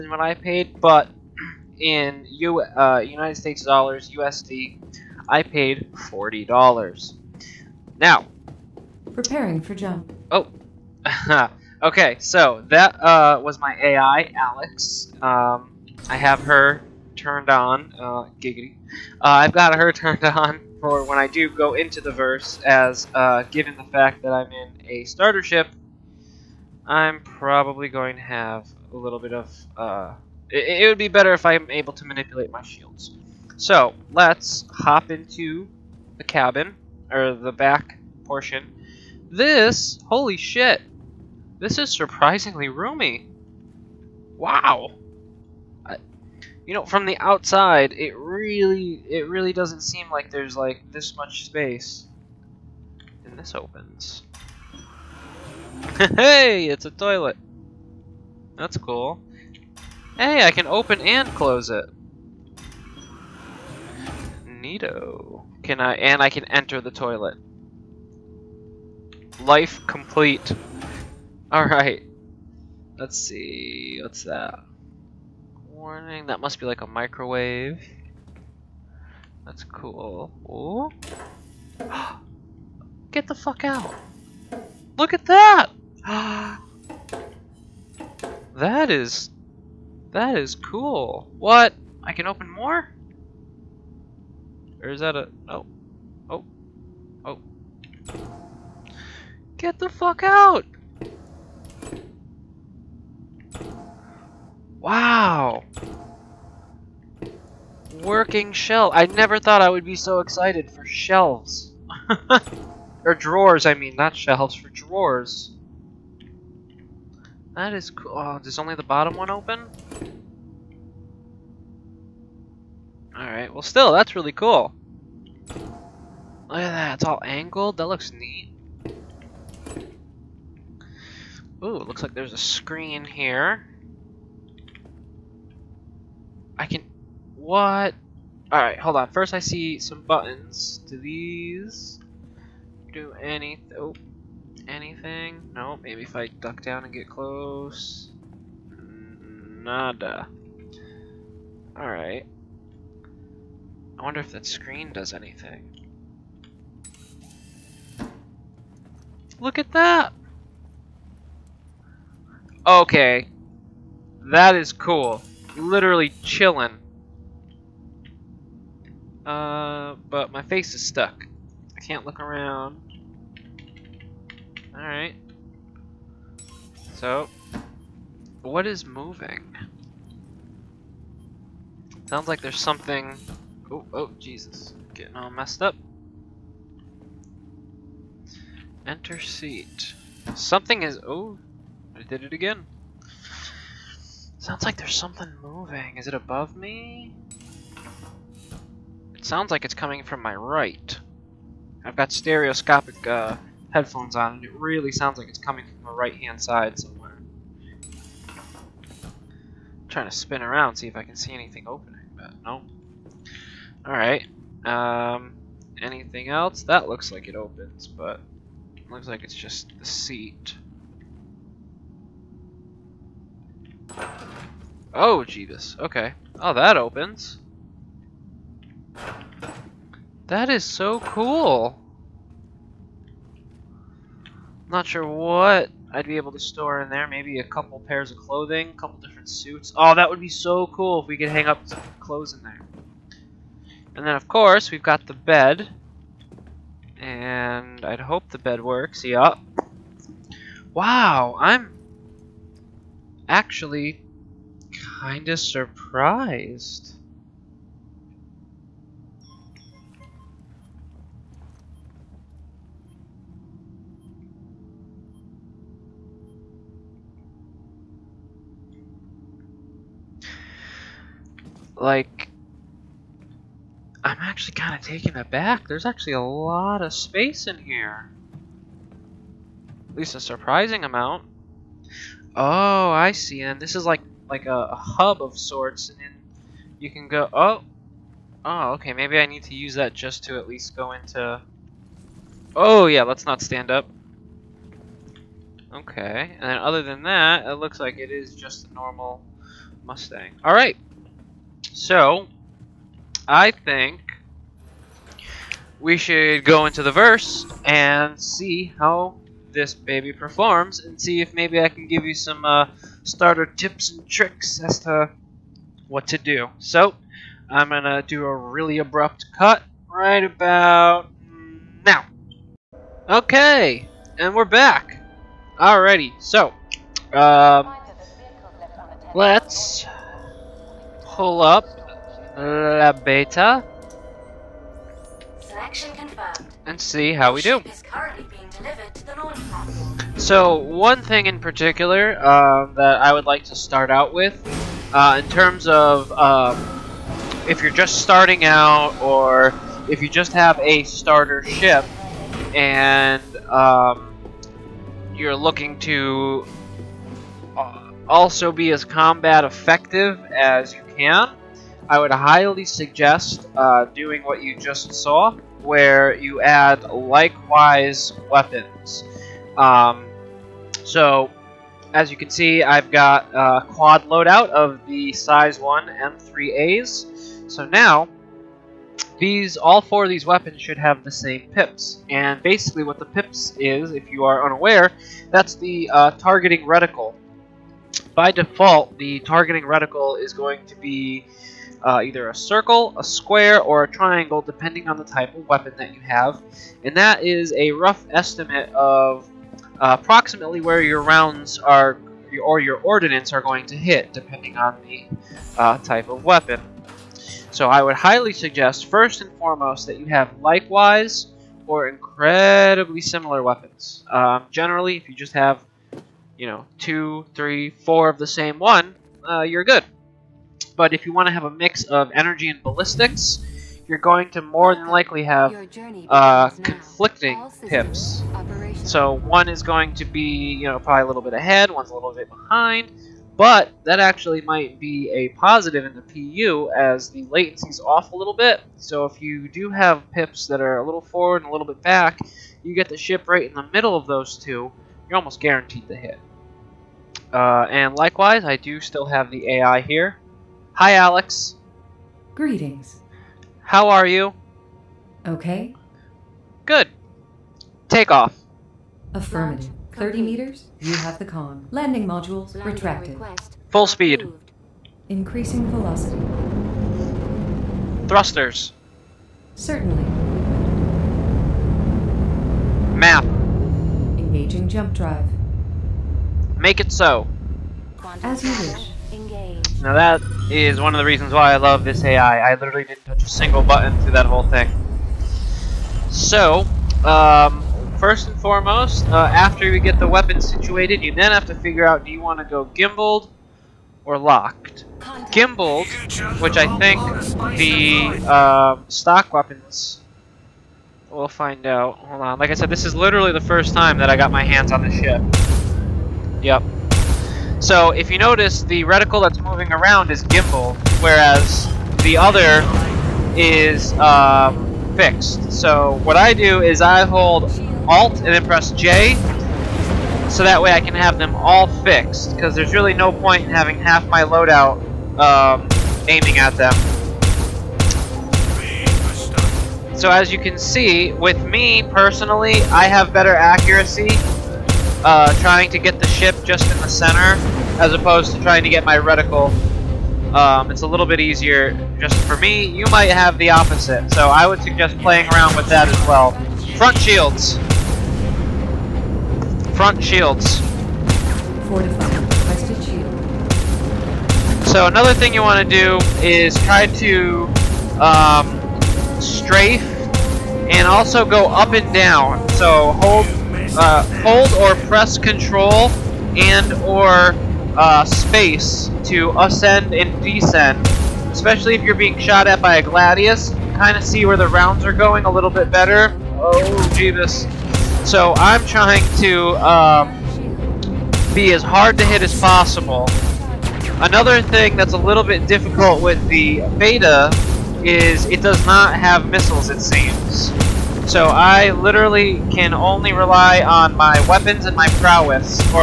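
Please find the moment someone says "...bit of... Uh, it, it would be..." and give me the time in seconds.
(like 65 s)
29 s.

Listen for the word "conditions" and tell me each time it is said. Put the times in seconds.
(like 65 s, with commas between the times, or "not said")
not said.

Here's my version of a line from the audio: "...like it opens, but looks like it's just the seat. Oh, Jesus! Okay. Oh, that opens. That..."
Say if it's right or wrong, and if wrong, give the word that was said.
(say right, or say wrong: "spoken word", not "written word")
right.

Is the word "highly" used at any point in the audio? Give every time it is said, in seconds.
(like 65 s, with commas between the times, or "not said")
362 s, 407 s.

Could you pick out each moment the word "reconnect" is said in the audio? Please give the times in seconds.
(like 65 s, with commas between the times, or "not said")
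not said.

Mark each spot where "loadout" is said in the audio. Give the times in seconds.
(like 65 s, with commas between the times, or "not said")
374 s, 524 s.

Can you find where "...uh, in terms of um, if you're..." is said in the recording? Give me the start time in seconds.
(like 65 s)
344 s.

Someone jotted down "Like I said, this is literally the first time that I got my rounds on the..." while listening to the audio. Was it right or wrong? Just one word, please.
wrong.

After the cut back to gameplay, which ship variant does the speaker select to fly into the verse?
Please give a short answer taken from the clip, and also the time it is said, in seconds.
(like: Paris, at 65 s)
La Beta, at 332 s.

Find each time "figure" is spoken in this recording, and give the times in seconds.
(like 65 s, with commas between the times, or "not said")
491 s.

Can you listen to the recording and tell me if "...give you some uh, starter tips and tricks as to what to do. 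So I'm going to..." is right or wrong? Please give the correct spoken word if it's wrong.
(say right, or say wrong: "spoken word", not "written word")
right.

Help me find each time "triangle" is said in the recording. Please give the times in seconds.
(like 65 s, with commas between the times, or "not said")
393 s.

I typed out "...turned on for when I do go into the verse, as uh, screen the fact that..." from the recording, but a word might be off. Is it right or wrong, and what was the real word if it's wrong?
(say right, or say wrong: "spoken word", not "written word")
wrong: "given", not "screen".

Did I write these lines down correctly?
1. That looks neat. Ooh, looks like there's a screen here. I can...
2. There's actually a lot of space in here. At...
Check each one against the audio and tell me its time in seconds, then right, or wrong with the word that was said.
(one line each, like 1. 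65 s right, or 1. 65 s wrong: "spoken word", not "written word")
1. 127 s right
2. 275 s right.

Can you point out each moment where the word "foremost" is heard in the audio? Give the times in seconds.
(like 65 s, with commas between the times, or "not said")
409 s, 488 s.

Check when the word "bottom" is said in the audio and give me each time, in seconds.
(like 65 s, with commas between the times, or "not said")
118 s.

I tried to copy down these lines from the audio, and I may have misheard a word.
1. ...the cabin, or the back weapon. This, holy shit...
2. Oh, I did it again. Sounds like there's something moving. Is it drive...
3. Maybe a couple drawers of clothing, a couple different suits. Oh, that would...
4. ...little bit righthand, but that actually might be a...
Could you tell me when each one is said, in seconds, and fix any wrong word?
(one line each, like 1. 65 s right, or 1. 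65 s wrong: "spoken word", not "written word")
1. 36 s wrong: "portion", not "weapon"
2. 191 s wrong: "above", not "drive"
3. 237 s wrong: "pairs", not "drawers"
4. 431 s wrong: "behind", not "righthand".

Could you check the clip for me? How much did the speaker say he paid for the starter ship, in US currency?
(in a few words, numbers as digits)
$40.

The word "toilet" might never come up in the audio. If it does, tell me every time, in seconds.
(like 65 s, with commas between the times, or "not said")
56 s, 66 s.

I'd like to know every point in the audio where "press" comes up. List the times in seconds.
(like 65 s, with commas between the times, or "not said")
518 s, 564 s.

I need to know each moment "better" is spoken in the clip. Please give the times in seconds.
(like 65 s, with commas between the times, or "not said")
31 s, 533 s, 575 s.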